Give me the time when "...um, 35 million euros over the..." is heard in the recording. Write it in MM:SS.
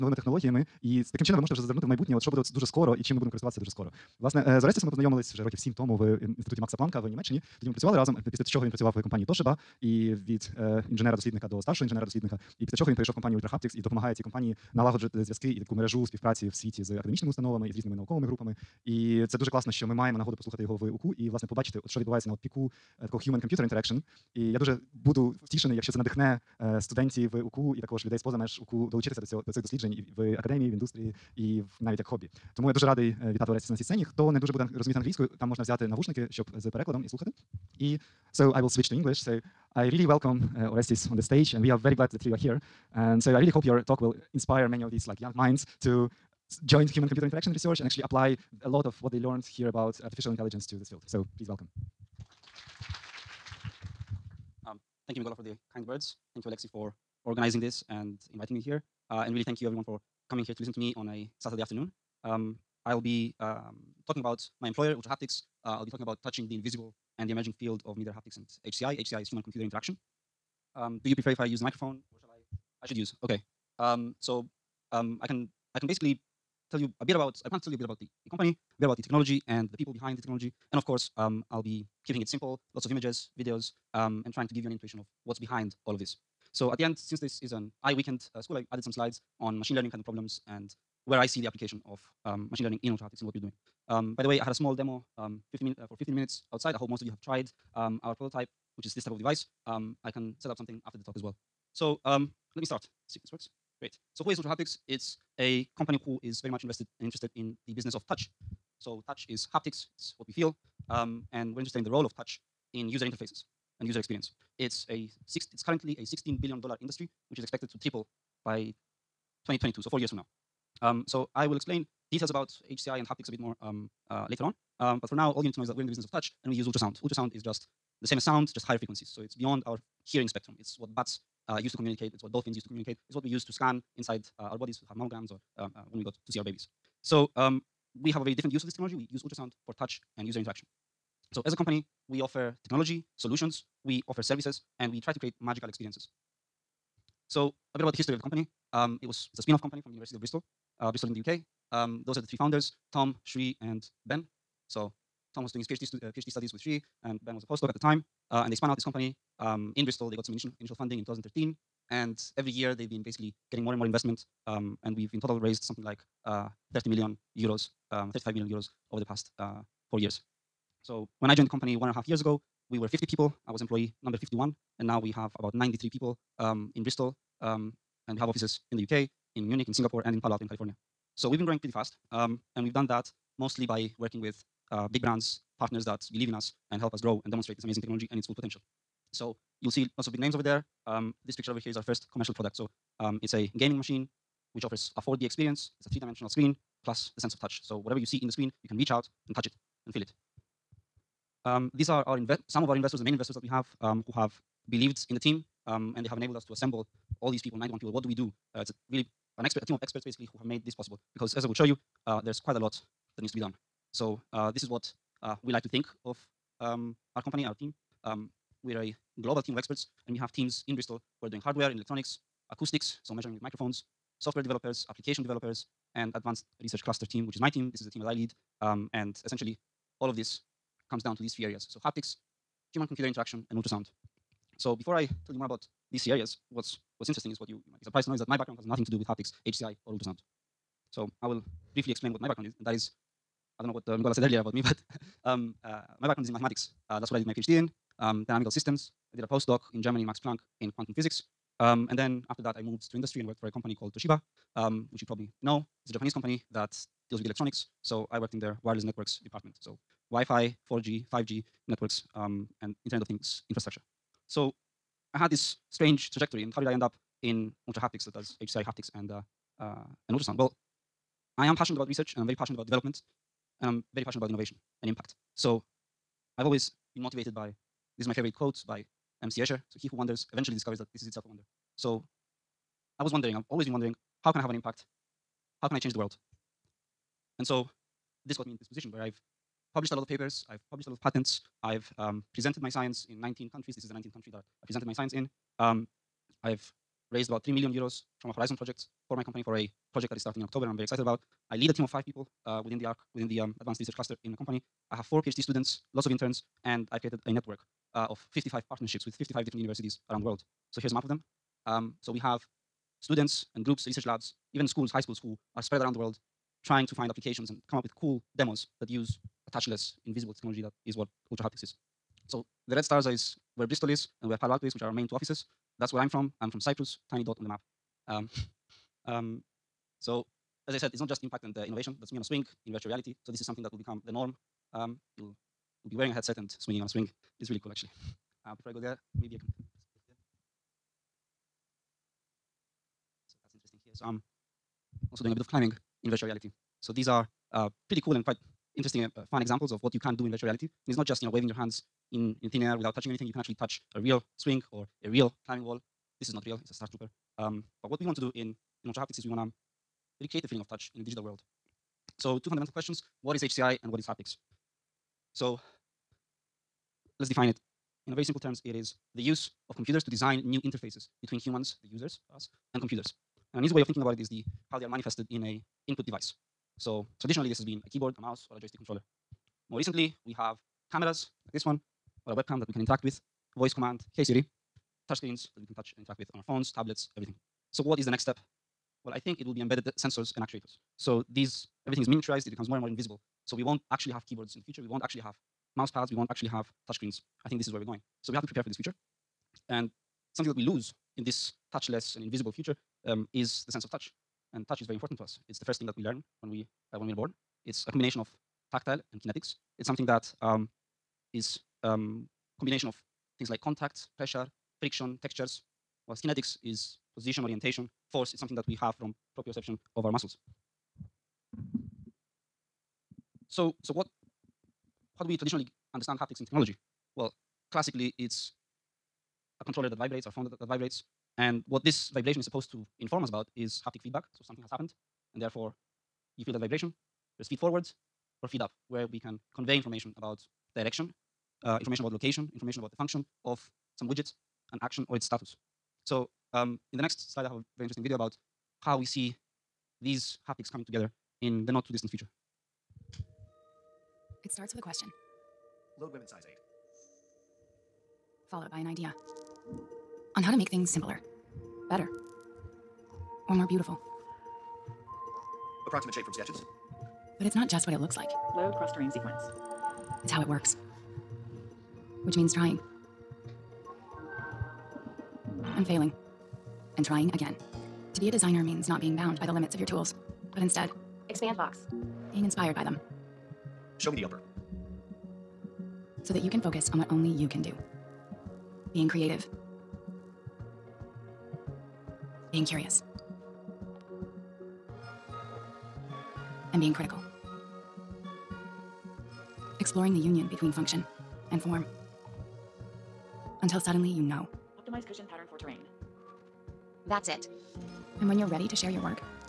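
02:47.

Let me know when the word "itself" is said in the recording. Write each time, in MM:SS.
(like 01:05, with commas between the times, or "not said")
04:41.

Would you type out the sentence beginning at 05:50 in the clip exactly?
And it's not just you know waving your hands in, in thin air without touching anything.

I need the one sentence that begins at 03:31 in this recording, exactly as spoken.
Because as I will show you, uh, there's quite a lot that needs to be done.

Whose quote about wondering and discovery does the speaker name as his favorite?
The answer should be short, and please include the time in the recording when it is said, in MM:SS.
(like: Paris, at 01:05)
M.C. Escher, at 04:39.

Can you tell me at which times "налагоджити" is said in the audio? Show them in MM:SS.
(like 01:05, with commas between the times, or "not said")
00:14.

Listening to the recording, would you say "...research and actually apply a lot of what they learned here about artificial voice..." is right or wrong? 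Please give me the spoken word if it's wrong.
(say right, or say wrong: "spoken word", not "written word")
wrong: "intelligence", not "voice".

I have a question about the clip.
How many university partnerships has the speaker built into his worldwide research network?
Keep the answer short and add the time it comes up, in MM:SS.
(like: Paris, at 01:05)
55, at 05:08.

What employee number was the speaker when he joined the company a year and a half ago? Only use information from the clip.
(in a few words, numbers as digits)
51.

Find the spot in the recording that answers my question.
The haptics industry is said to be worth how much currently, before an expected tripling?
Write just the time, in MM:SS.
01:56.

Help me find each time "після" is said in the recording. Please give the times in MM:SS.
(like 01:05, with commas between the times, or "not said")
00:08, 00:12.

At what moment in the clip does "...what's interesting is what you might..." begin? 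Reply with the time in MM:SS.
03:57.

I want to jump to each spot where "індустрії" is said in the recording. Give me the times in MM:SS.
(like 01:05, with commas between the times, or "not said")
00:30.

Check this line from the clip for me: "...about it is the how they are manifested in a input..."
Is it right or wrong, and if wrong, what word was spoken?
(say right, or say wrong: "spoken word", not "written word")
right.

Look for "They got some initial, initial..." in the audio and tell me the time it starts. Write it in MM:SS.
02:40.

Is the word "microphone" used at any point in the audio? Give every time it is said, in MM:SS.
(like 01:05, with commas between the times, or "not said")
01:11, 03:43.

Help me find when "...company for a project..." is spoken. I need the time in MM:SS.
04:59.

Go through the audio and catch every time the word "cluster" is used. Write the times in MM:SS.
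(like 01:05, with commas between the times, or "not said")
03:46, 05:03.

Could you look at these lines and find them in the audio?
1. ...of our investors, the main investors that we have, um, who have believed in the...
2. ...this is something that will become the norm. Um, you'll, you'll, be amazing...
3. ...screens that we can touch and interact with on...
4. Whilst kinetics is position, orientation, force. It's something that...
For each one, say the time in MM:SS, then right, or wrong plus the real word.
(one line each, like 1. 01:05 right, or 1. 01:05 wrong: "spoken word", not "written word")
1. 03:22 right
2. 05:33 wrong: "wearing", not "amazing"
3. 06:25 right
4. 06:56 right.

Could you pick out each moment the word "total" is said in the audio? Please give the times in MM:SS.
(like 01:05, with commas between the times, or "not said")
02:45.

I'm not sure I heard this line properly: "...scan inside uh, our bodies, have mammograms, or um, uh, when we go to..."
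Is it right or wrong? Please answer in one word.
right.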